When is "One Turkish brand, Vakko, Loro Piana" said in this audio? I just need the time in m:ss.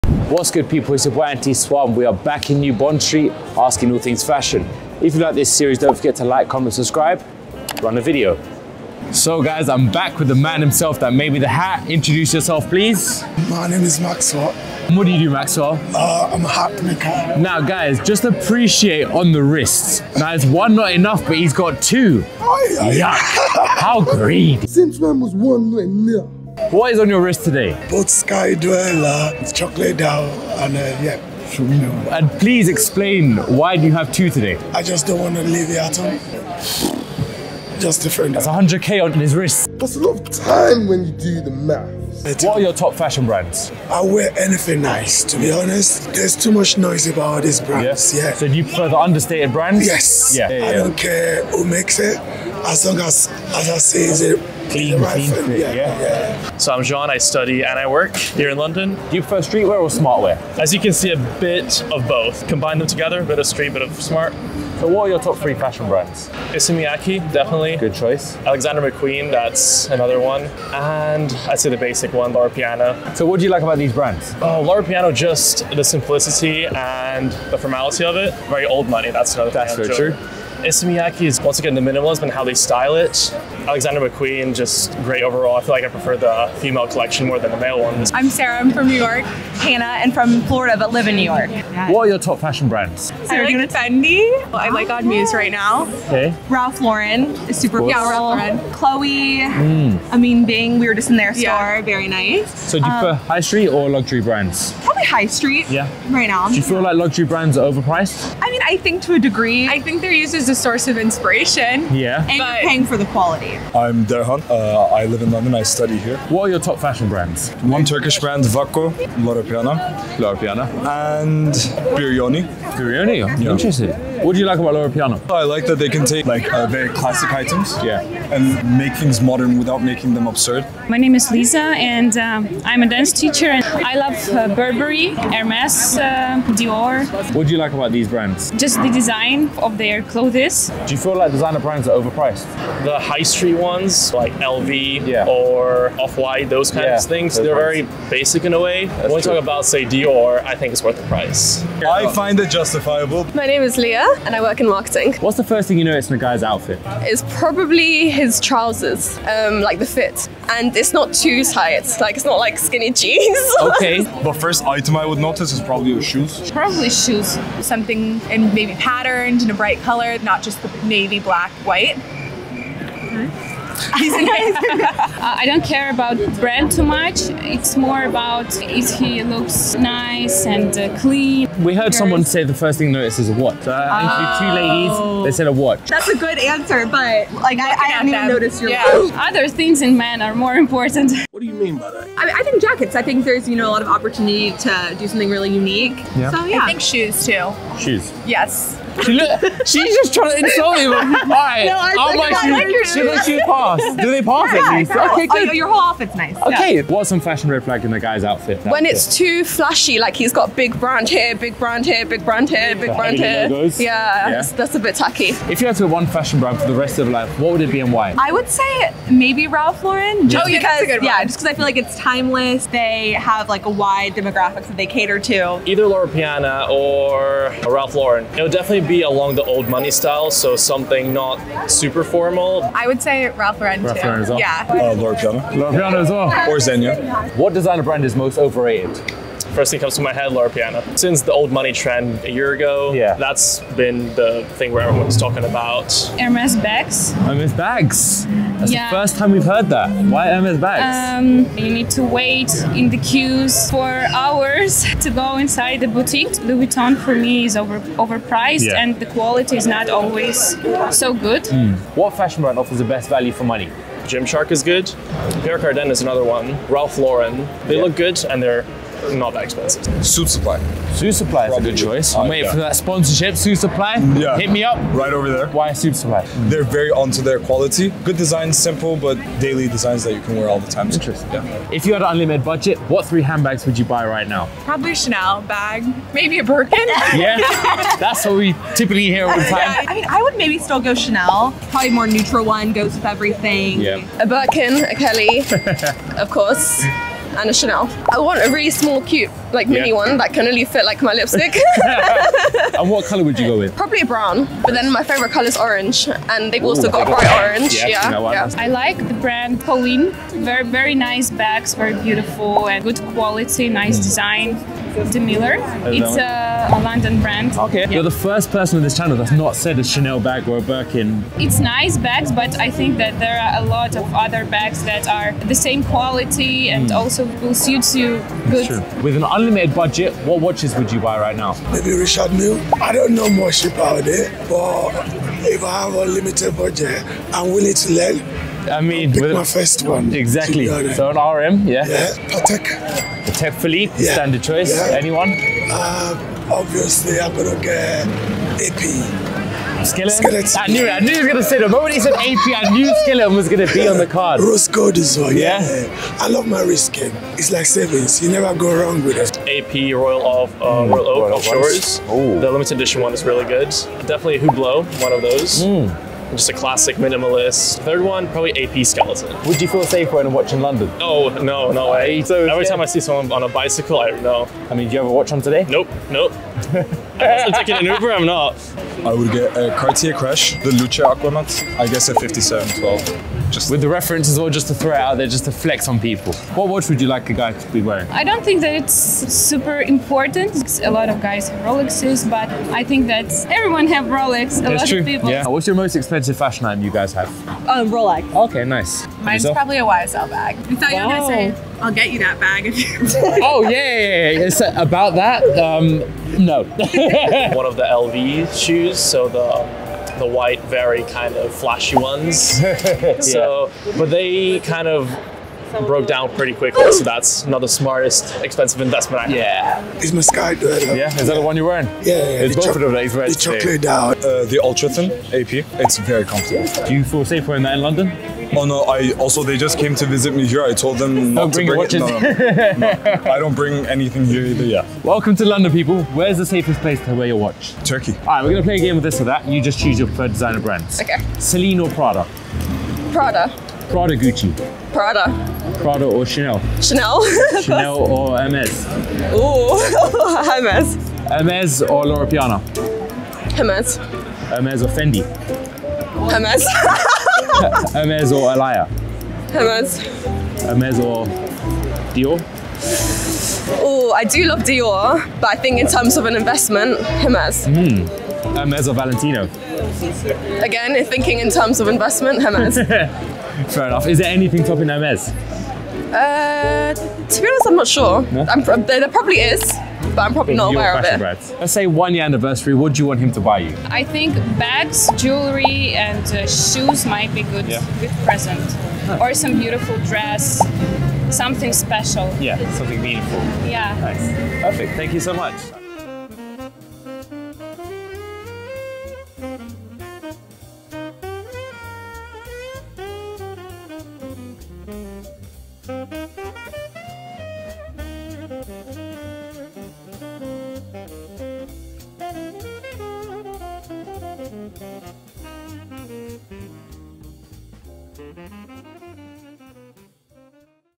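1:57.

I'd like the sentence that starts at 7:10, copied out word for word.
I told them not bring to bring it.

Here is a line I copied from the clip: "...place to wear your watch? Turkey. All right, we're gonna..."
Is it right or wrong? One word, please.
right.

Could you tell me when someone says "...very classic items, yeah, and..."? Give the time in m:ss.
2:06.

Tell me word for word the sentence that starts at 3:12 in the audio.
I think there's you know a lot of opportunity to do something really unique.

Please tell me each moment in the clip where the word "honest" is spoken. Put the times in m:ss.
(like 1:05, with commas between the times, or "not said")
0:45, 7:57.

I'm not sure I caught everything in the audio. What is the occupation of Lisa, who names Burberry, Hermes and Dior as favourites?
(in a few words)
Dance teacher.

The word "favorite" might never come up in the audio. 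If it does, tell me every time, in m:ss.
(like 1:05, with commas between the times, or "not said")
5:05.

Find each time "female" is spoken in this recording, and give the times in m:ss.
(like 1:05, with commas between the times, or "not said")
1:26.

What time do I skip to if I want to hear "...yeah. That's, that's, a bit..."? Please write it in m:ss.
3:33.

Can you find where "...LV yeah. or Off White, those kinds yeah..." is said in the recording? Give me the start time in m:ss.
2:24.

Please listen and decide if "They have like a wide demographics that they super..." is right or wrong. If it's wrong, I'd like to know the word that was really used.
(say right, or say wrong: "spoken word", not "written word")
wrong: "cater", not "super".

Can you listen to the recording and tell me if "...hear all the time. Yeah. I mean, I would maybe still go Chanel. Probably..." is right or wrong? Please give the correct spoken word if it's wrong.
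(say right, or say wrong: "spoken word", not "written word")
right.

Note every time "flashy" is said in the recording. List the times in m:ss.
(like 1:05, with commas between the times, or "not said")
3:29, 6:51.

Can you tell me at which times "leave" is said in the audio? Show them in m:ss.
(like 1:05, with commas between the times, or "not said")
0:35.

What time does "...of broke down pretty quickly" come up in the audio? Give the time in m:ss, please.
6:54.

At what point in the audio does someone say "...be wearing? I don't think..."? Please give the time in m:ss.
6:27.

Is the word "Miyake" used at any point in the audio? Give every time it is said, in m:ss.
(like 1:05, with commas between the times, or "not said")
1:06, 1:20.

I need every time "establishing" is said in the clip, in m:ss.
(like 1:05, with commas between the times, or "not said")
not said.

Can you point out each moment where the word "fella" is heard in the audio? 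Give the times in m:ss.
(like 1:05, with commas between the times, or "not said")
not said.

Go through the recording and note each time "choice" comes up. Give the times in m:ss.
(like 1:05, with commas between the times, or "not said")
1:07, 4:31, 5:44.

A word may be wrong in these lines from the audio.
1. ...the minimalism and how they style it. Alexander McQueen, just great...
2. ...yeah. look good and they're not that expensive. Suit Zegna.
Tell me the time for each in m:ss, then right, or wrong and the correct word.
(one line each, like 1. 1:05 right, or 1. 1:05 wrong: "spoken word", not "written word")
1. 1:21 right
2. 4:27 wrong: "Supply", not "Zegna".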